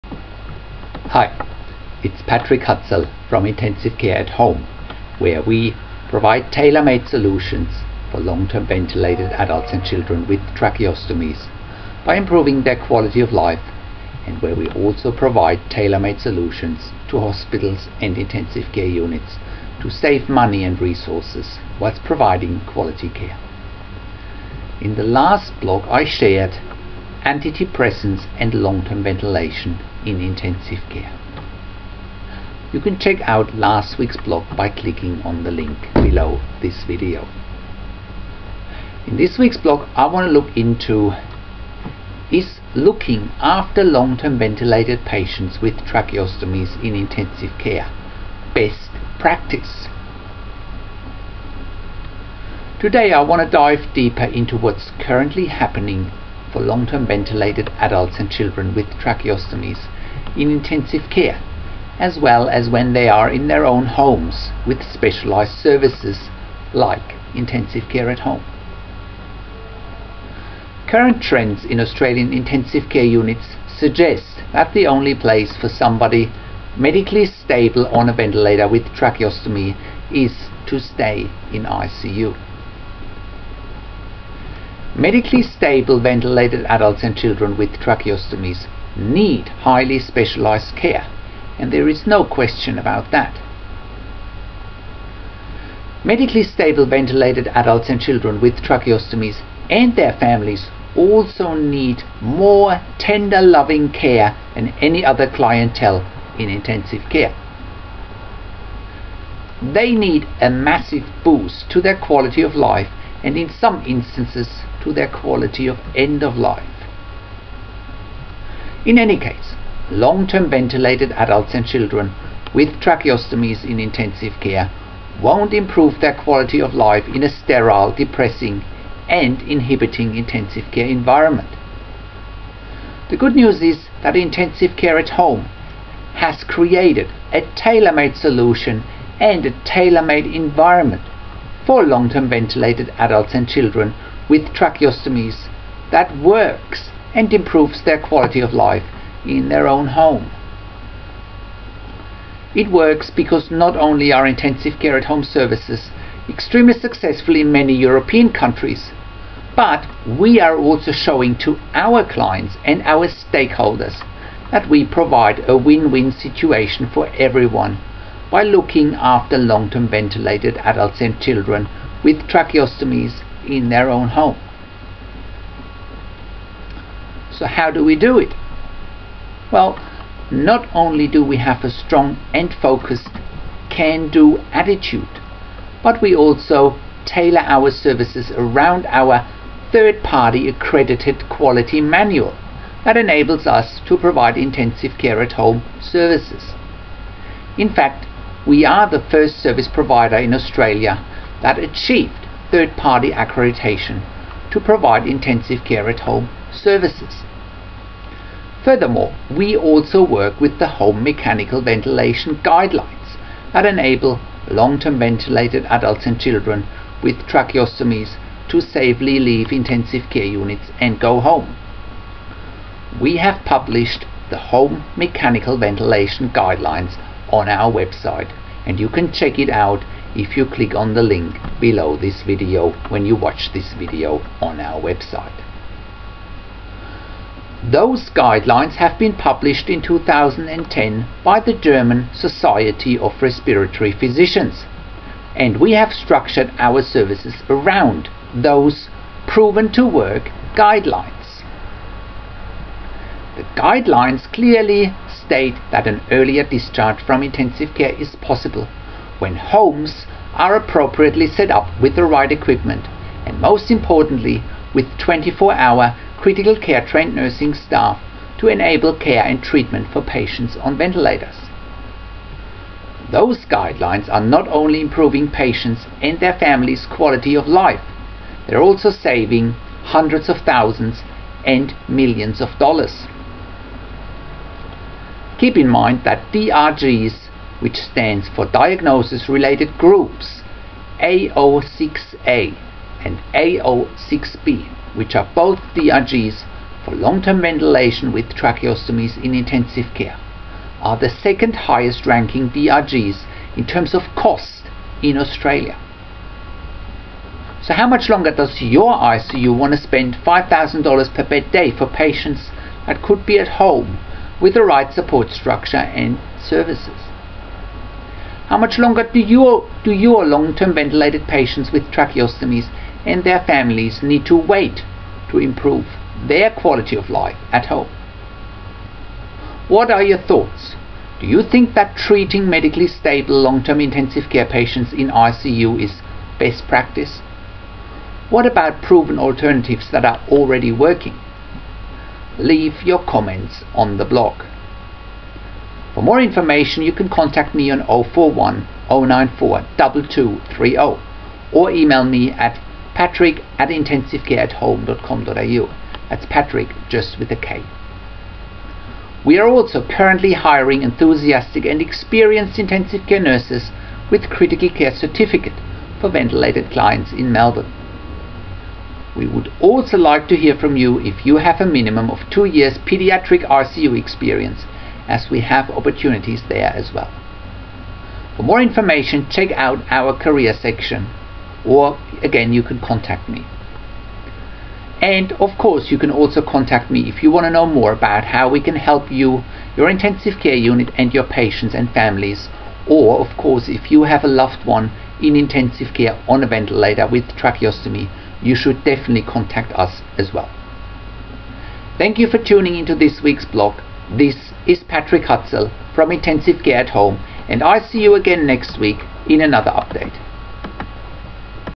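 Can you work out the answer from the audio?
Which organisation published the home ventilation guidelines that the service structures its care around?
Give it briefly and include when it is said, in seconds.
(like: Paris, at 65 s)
German Society of Respiratory Physicians, at 241 s.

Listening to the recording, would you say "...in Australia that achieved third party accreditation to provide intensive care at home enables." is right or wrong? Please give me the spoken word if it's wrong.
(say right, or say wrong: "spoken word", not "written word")
wrong: "services", not "enables".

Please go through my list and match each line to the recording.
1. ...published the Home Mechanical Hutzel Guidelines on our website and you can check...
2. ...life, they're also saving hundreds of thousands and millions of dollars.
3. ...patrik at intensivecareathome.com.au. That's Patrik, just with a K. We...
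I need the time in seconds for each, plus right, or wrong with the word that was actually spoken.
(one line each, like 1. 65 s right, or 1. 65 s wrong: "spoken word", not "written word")
1. 223 s wrong: "Ventilation", not "Hutzel"
2. 277 s right
3. 352 s right.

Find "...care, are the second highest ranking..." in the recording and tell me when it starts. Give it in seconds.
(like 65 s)
299 s.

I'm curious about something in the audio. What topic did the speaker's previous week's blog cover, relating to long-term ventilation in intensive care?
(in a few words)
Antidepressants.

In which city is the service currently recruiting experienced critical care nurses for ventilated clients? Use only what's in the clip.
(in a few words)
Melbourne.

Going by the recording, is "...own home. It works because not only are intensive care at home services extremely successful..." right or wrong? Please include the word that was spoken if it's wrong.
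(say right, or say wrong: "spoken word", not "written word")
right.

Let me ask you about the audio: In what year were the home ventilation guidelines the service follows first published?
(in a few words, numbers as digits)
2010.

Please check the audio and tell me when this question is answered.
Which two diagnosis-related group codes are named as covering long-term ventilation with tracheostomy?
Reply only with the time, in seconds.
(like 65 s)
291 s.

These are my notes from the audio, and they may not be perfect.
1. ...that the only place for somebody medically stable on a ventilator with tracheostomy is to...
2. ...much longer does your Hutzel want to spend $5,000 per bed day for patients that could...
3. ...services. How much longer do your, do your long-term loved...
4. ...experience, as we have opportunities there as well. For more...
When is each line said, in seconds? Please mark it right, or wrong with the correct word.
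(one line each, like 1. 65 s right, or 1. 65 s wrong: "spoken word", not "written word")
1. 74 s right
2. 307 s wrong: "ICU", not "Hutzel"
3. 316 s wrong: "ventilated", not "loved"
4. 373 s right.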